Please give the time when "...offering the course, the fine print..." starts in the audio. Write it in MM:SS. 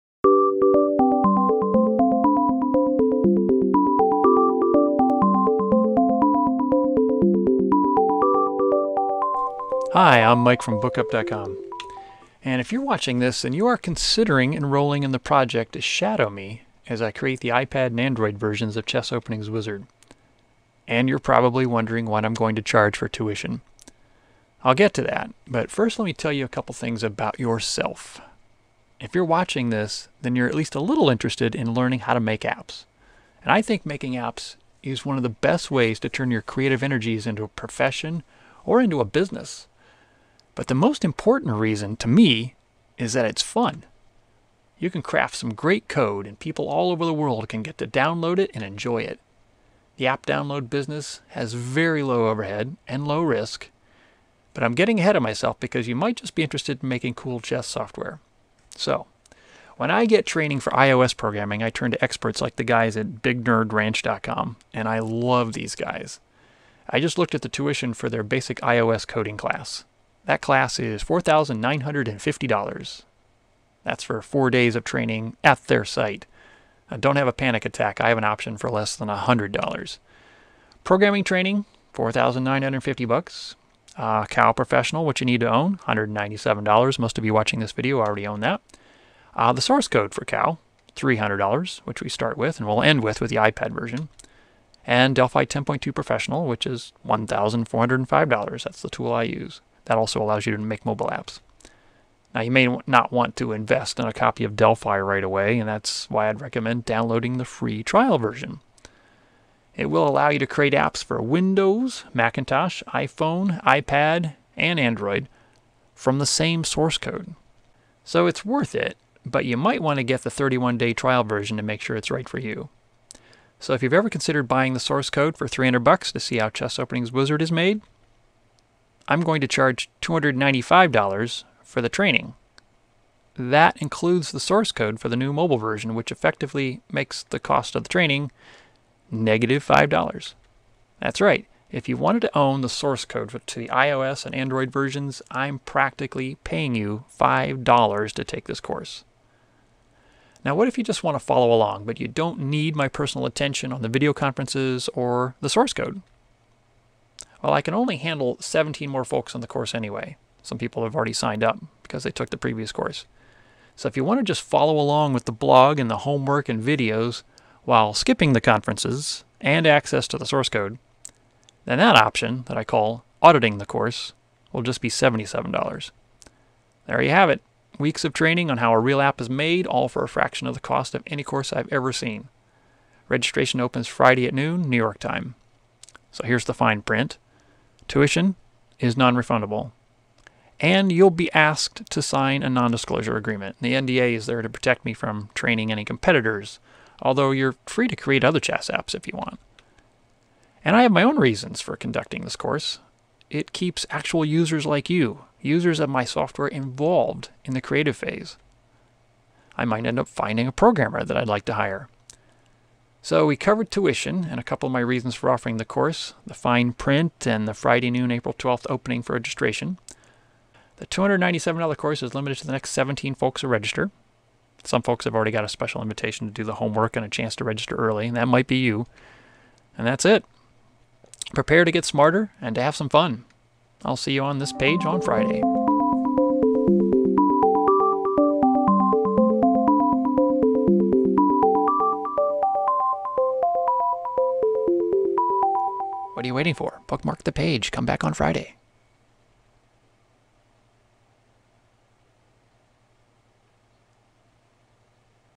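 03:35.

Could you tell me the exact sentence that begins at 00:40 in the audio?
But the most important reason to me is that it's fun.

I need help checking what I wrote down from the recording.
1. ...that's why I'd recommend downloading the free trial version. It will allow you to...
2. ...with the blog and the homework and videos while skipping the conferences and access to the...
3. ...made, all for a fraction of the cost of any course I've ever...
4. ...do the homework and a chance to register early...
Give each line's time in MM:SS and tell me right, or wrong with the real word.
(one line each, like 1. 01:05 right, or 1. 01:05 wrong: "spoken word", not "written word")
1. 01:45 right
2. 02:45 right
3. 02:59 right
4. 03:46 right.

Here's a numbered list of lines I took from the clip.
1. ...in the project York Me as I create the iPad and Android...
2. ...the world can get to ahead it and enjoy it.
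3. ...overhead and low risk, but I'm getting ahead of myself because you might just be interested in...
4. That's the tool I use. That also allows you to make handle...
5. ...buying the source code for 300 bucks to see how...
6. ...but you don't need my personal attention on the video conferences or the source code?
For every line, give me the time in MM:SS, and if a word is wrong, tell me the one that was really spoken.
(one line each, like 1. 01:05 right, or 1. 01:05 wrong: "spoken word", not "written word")
1. 00:15 wrong: "Shadow", not "York"
2. 00:47 wrong: "download", not "ahead"
3. 00:52 right
4. 01:38 wrong: "mobile", not "handle"
5. 02:04 right
6. 02:31 right.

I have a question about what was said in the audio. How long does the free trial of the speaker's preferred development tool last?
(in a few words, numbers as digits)
31 days.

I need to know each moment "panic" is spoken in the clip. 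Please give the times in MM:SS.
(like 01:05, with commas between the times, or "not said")
01:17.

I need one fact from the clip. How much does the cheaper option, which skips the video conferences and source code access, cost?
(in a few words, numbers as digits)
$77.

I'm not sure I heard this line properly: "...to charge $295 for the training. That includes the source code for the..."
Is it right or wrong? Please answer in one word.
right.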